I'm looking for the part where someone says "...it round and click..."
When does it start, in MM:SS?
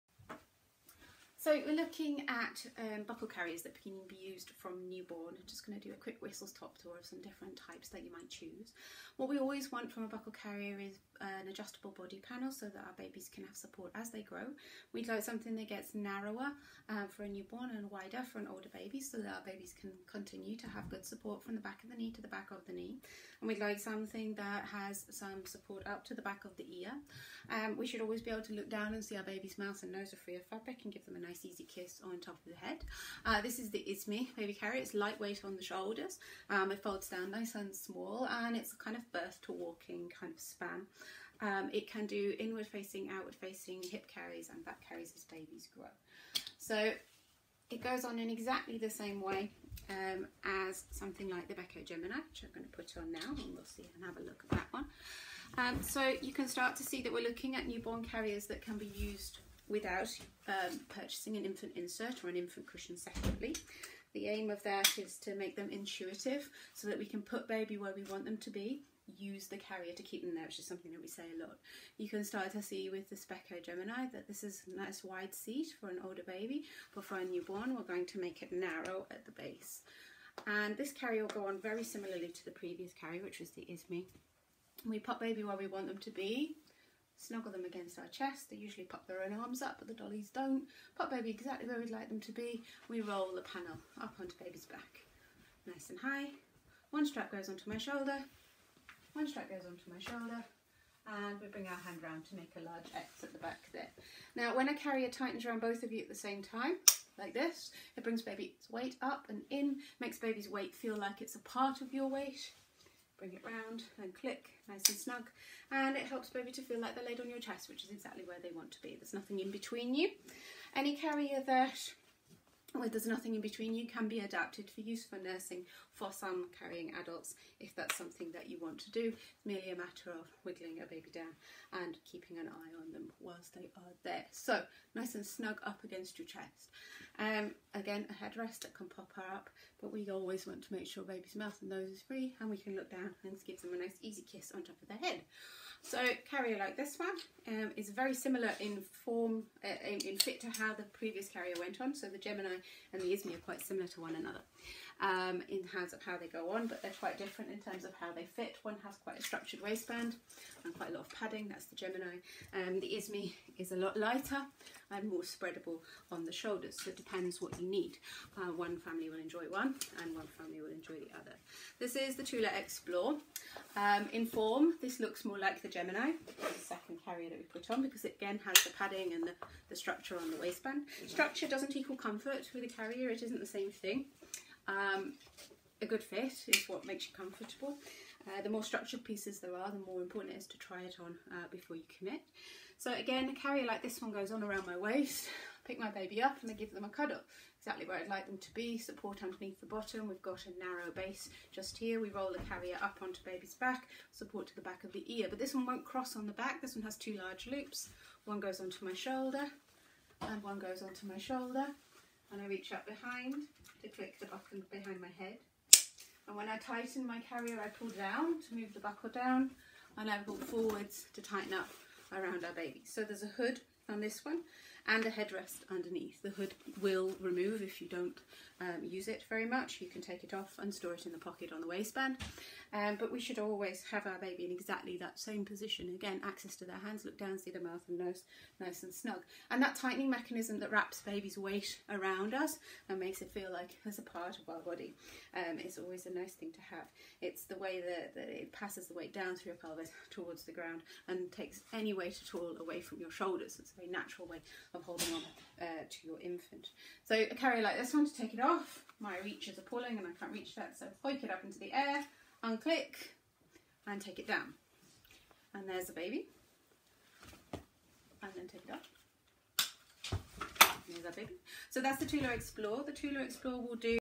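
01:53.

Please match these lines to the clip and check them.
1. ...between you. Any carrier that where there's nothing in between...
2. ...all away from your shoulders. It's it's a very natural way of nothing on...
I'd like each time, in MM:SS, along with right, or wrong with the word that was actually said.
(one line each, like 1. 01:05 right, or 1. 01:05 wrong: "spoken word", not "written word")
1. 01:59 right
2. 04:12 wrong: "holding", not "nothing".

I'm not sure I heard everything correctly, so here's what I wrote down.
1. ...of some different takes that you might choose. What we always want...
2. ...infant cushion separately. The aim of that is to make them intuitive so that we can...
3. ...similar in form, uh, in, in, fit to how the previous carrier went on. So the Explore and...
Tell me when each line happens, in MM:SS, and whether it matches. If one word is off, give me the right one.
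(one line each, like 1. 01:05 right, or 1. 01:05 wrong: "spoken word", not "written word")
1. 00:06 wrong: "types", not "takes"
2. 01:02 right
3. 02:28 wrong: "Gemini", not "Explore".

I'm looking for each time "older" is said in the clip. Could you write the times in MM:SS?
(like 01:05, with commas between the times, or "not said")
00:18, 01:16.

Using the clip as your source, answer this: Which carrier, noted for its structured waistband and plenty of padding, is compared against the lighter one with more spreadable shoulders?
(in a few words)
Beco Gemini.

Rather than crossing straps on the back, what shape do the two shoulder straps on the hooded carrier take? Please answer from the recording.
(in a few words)
two large loops.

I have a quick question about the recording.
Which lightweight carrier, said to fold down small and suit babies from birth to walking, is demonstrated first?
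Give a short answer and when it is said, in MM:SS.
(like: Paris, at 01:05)
Izmi Baby Carrier, at 00:33.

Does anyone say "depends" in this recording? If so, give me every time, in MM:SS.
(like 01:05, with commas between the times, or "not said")
02:46.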